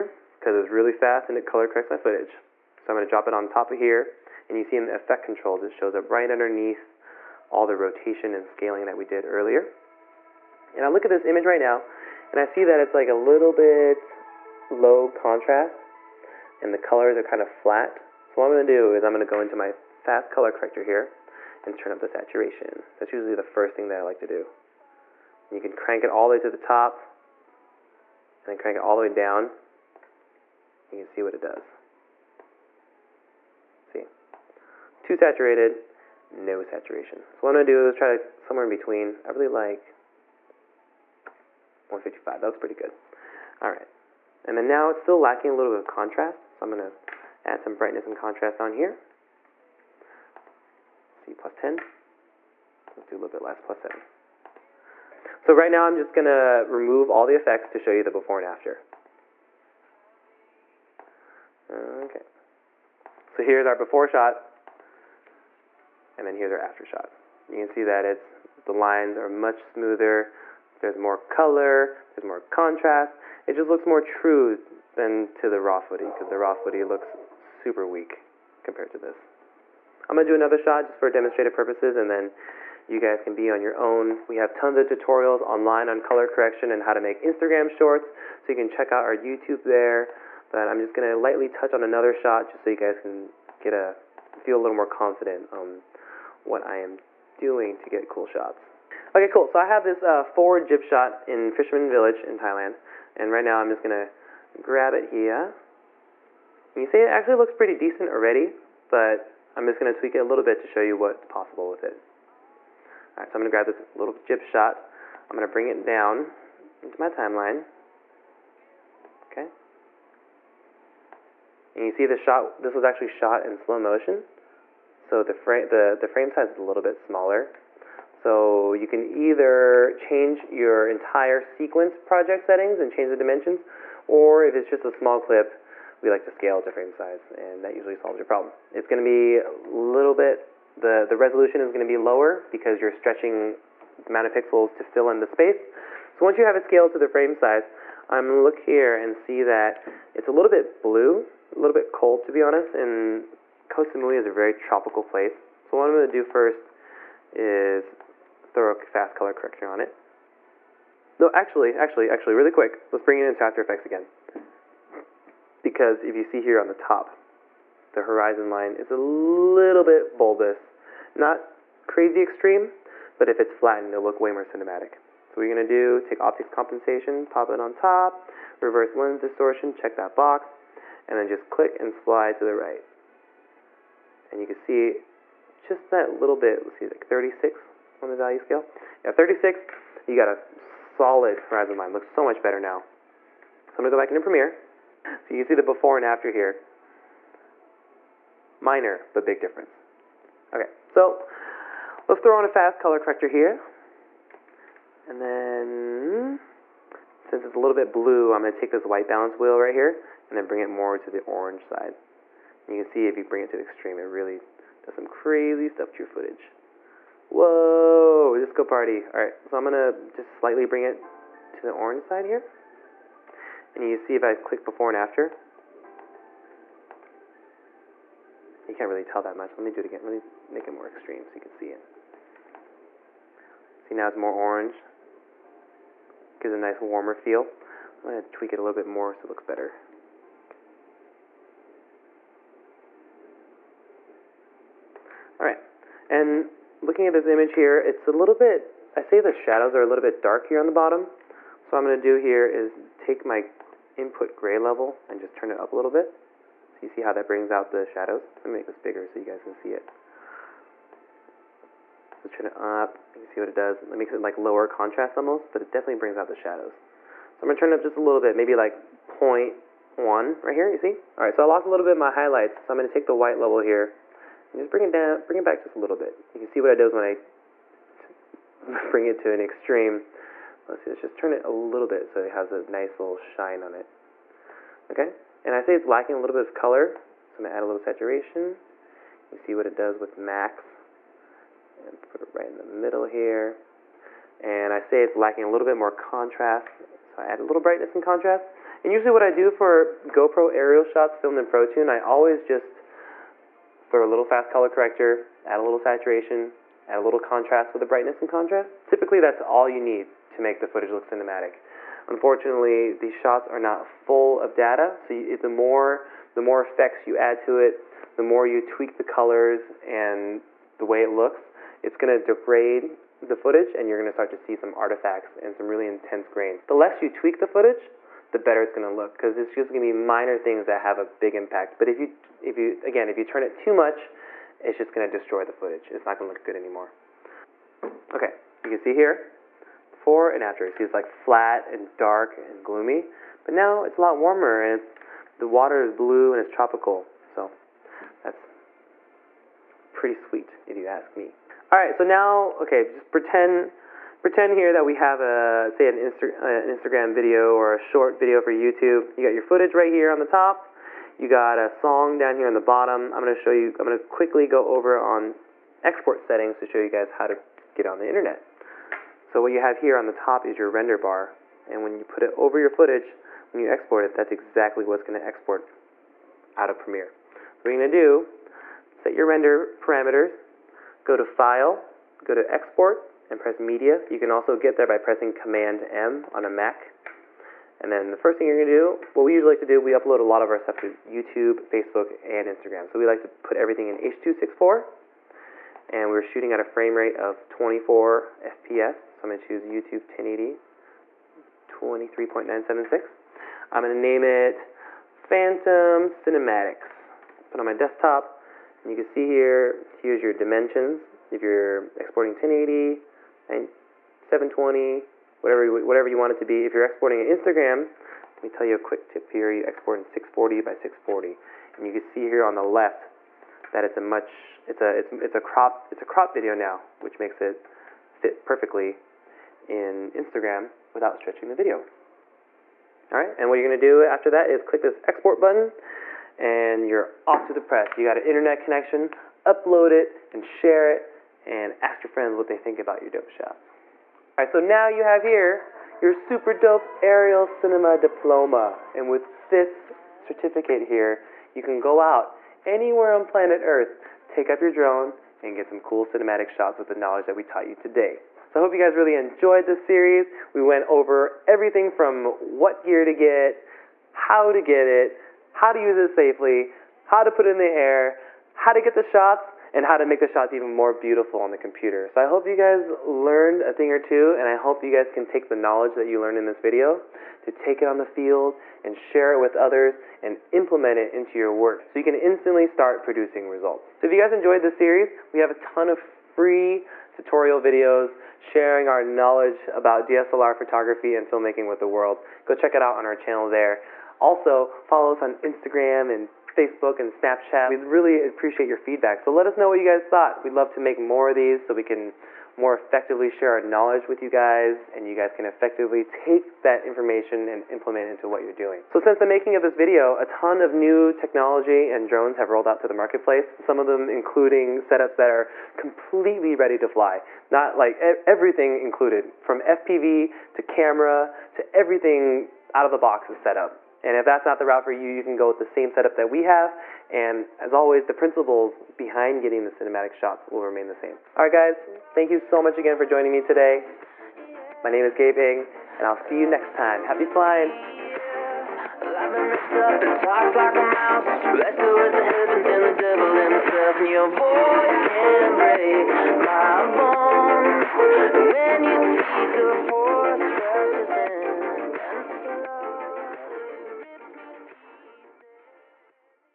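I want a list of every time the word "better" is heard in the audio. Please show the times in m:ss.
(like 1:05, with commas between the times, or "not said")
3:12, 3:59, 5:28.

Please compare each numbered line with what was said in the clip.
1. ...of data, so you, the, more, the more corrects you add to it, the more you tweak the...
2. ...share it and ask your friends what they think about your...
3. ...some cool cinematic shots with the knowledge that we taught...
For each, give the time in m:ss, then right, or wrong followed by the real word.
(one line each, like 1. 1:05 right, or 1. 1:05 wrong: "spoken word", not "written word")
1. 5:14 wrong: "effects", not "corrects"
2. 7:20 right
3. 7:35 right.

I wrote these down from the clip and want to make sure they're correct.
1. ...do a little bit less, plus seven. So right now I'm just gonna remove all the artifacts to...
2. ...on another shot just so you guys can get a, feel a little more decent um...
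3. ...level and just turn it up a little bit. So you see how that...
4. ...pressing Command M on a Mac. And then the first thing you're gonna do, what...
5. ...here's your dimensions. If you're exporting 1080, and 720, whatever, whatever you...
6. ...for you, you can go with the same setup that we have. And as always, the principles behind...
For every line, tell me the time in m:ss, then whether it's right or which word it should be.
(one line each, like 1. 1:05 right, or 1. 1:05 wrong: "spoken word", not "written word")
1. 0:53 wrong: "effects", not "artifacts"
2. 1:31 wrong: "confident", not "decent"
3. 4:14 right
4. 6:24 right
5. 6:49 right
6. 8:44 right.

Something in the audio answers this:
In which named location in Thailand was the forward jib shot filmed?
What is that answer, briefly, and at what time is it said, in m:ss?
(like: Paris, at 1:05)
Fisherman Village, at 1:41.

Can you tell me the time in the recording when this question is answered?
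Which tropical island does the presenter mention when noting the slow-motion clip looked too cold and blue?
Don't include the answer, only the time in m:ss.
2:33.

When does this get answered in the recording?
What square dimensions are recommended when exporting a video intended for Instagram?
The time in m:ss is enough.
7:00.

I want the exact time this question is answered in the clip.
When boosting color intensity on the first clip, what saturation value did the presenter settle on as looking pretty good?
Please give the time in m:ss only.
0:41.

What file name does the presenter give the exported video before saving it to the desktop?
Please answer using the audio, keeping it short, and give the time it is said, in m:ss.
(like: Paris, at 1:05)
Phantom Cinematics, at 6:45.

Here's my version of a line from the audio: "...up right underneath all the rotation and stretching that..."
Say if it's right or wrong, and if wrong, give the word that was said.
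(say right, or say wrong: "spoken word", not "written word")
wrong: "scaling", not "stretching".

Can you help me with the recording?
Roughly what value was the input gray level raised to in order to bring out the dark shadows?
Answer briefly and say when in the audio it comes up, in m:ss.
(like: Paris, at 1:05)
0.1, at 4:29.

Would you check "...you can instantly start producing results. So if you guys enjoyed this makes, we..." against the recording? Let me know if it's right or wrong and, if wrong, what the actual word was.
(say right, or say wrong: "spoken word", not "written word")
wrong: "series", not "makes".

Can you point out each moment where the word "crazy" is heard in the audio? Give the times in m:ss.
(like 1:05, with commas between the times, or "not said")
2:51, 3:35.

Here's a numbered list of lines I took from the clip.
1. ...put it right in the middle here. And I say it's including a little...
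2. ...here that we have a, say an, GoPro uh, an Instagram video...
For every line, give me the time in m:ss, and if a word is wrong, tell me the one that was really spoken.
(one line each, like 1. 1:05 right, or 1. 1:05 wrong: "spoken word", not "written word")
1. 4:52 wrong: "lacking", not "including"
2. 5:54 wrong: "Insta", not "GoPro".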